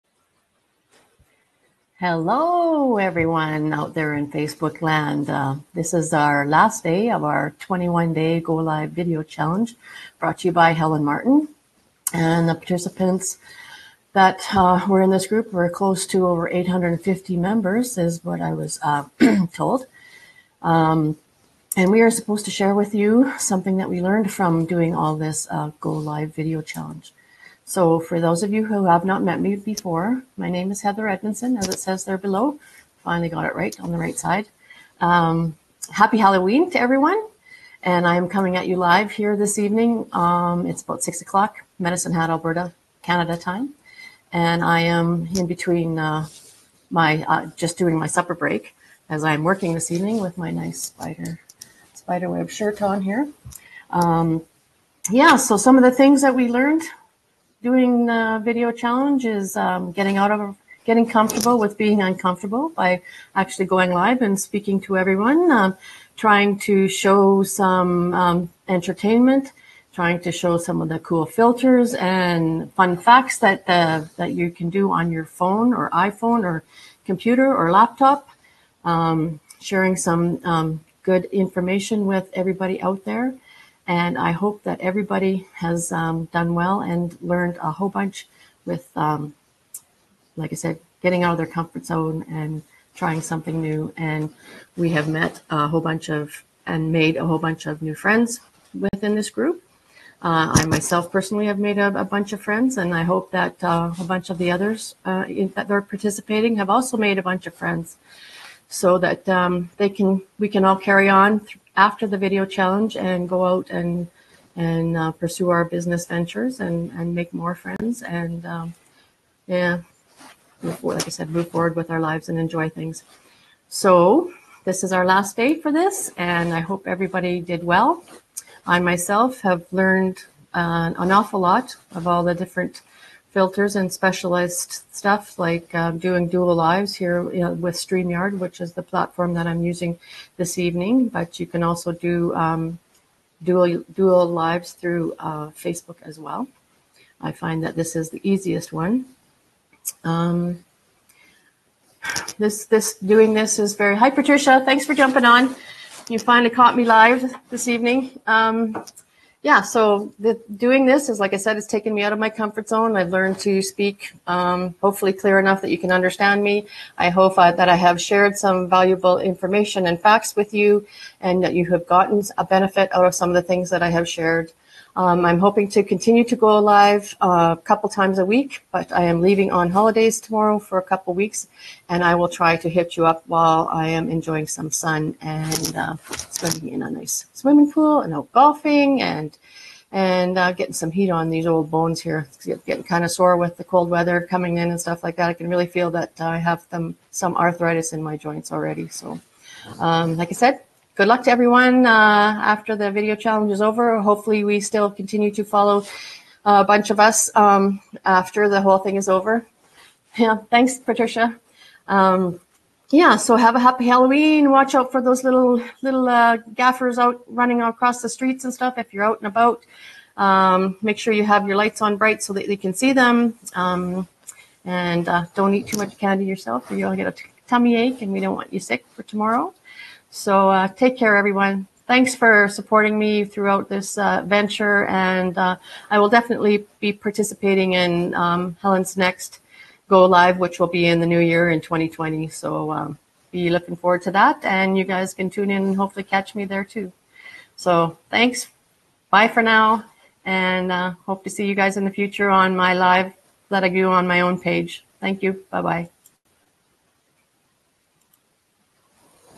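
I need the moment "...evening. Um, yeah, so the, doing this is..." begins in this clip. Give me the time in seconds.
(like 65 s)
157 s.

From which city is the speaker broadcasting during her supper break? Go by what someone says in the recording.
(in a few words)
Medicine Hat.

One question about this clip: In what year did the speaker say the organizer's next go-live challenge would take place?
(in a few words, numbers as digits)
2020.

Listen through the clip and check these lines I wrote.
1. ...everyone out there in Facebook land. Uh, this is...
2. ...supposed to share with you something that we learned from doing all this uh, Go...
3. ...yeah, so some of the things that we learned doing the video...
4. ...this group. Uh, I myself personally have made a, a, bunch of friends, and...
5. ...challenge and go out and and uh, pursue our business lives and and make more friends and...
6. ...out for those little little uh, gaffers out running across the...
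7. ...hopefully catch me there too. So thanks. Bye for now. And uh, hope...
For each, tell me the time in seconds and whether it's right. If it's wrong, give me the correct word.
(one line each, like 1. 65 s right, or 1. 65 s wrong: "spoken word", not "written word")
1. 2 s right
2. 22 s right
3. 55 s right
4. 99 s right
5. 112 s wrong: "ventures", not "lives"
6. 214 s right
7. 245 s right.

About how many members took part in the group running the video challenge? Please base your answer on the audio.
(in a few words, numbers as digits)
850.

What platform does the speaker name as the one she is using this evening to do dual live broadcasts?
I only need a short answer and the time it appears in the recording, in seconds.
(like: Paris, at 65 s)
StreamYard, at 137 s.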